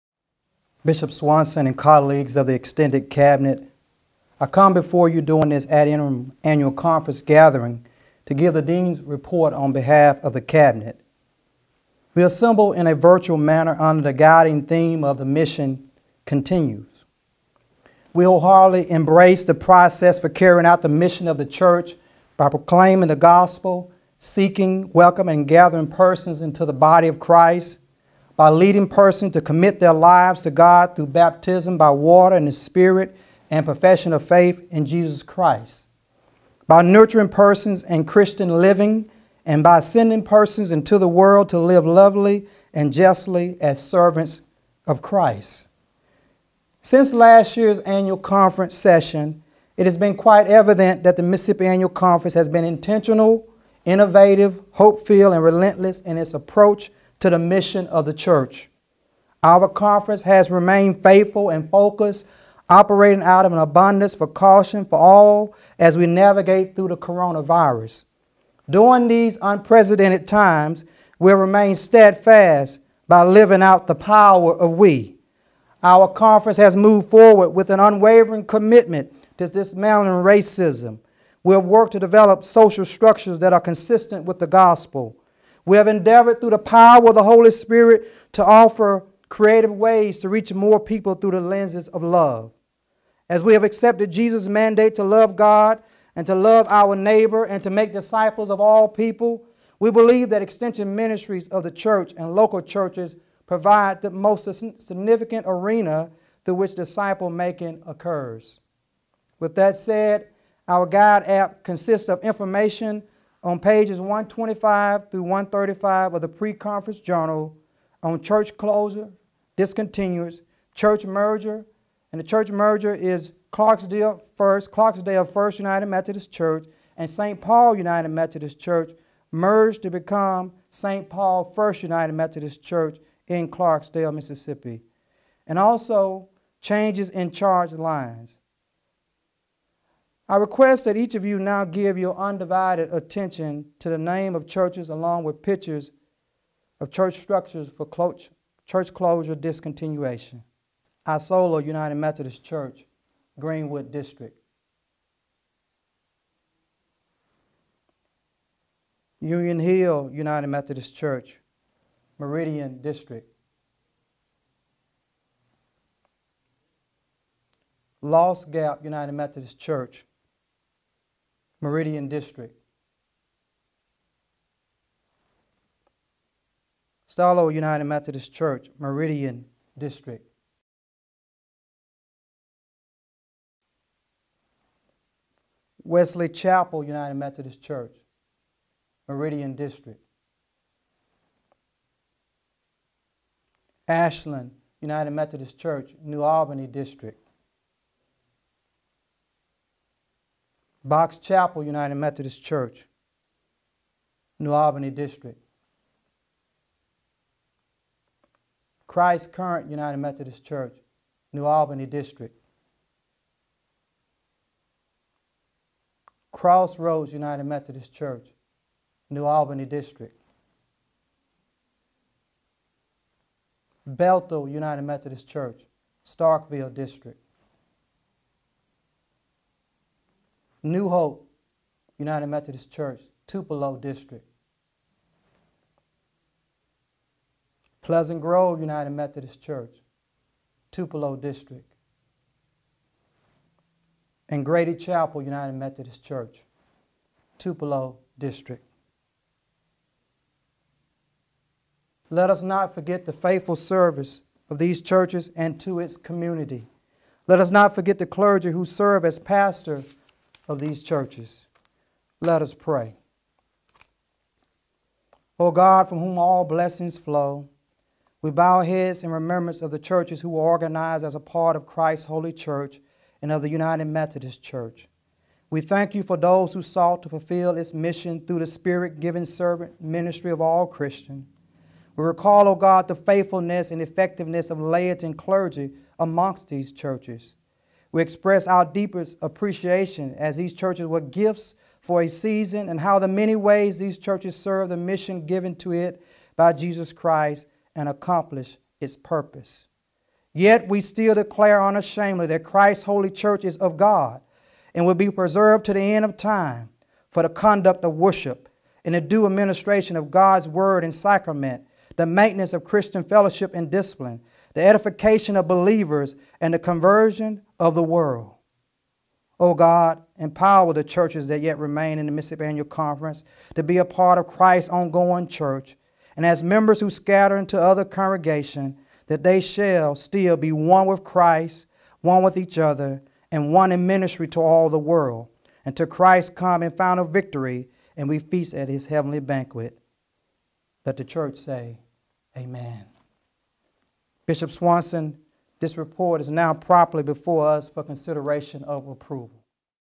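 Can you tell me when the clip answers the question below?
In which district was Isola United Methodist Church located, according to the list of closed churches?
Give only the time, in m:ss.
2:33.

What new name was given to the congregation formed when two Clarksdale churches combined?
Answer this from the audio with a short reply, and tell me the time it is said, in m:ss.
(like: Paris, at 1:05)
St. Paul First United Methodist Church, at 2:10.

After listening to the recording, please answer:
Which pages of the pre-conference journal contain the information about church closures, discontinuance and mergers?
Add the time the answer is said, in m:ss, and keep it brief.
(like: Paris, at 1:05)
125 through 135, at 1:53.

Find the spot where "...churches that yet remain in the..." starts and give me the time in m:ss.
5:20.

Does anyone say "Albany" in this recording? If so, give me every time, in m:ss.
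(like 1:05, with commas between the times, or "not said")
3:16, 3:24, 3:31, 3:39.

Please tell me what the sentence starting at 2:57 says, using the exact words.
Stallo United Methodist Church, Meridian District.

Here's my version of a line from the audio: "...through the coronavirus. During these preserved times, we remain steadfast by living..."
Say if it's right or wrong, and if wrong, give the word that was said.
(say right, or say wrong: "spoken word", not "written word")
wrong: "unprecedented", not "preserved".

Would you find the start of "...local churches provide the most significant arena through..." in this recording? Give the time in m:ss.
1:42.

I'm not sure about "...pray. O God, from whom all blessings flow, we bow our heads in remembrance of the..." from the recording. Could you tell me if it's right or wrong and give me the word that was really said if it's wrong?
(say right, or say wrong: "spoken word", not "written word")
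right.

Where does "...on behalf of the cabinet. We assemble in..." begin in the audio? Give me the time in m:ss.
0:09.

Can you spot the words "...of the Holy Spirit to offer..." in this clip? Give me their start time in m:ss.
1:27.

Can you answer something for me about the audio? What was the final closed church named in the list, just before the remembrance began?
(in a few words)
Grady Chapel United Methodist Church.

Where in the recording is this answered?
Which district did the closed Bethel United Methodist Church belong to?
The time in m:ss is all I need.
3:46.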